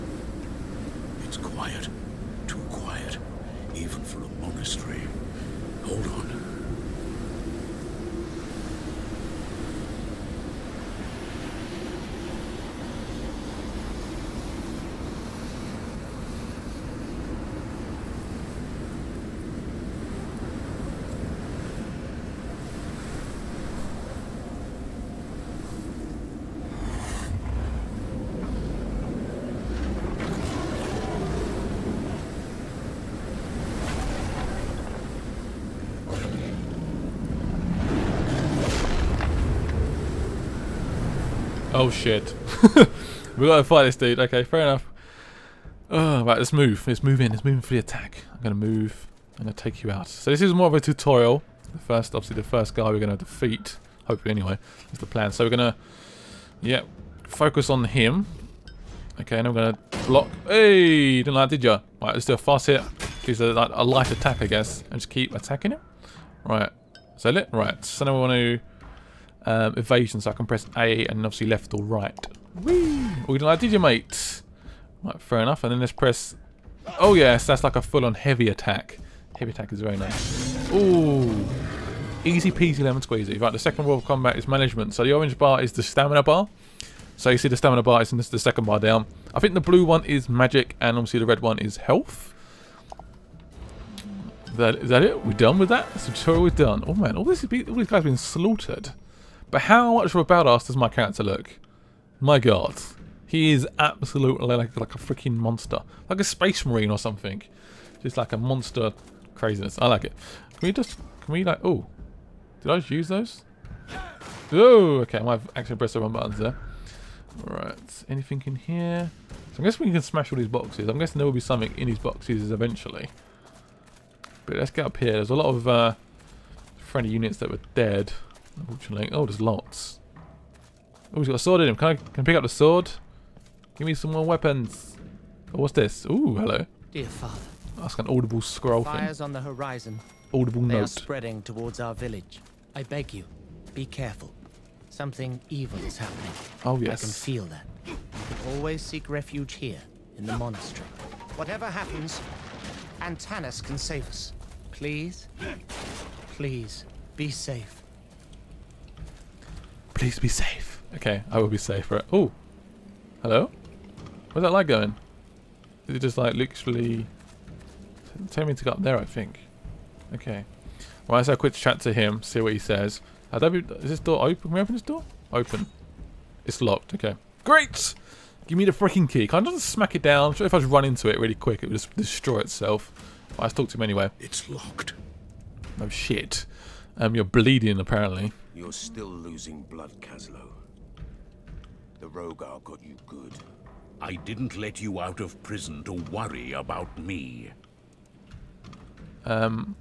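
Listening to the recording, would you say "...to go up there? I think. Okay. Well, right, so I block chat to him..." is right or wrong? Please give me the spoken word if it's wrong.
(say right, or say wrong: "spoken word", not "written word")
wrong: "quick", not "block".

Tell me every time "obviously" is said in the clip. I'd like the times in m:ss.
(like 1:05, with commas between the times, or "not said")
0:52, 1:11, 1:30.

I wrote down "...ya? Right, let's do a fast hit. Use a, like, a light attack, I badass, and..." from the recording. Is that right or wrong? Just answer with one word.
wrong.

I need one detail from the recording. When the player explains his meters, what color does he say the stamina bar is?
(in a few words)
Orange.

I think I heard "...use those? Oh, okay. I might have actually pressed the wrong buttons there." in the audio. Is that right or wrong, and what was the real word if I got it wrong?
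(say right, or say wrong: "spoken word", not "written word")
right.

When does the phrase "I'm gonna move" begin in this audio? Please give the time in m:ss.
0:48.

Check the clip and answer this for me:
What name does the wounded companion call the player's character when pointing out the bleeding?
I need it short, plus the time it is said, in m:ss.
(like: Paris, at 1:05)
Kaslo, at 3:10.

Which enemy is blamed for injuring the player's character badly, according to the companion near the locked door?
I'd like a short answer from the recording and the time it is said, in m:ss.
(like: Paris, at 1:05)
The Rhogar, at 3:11.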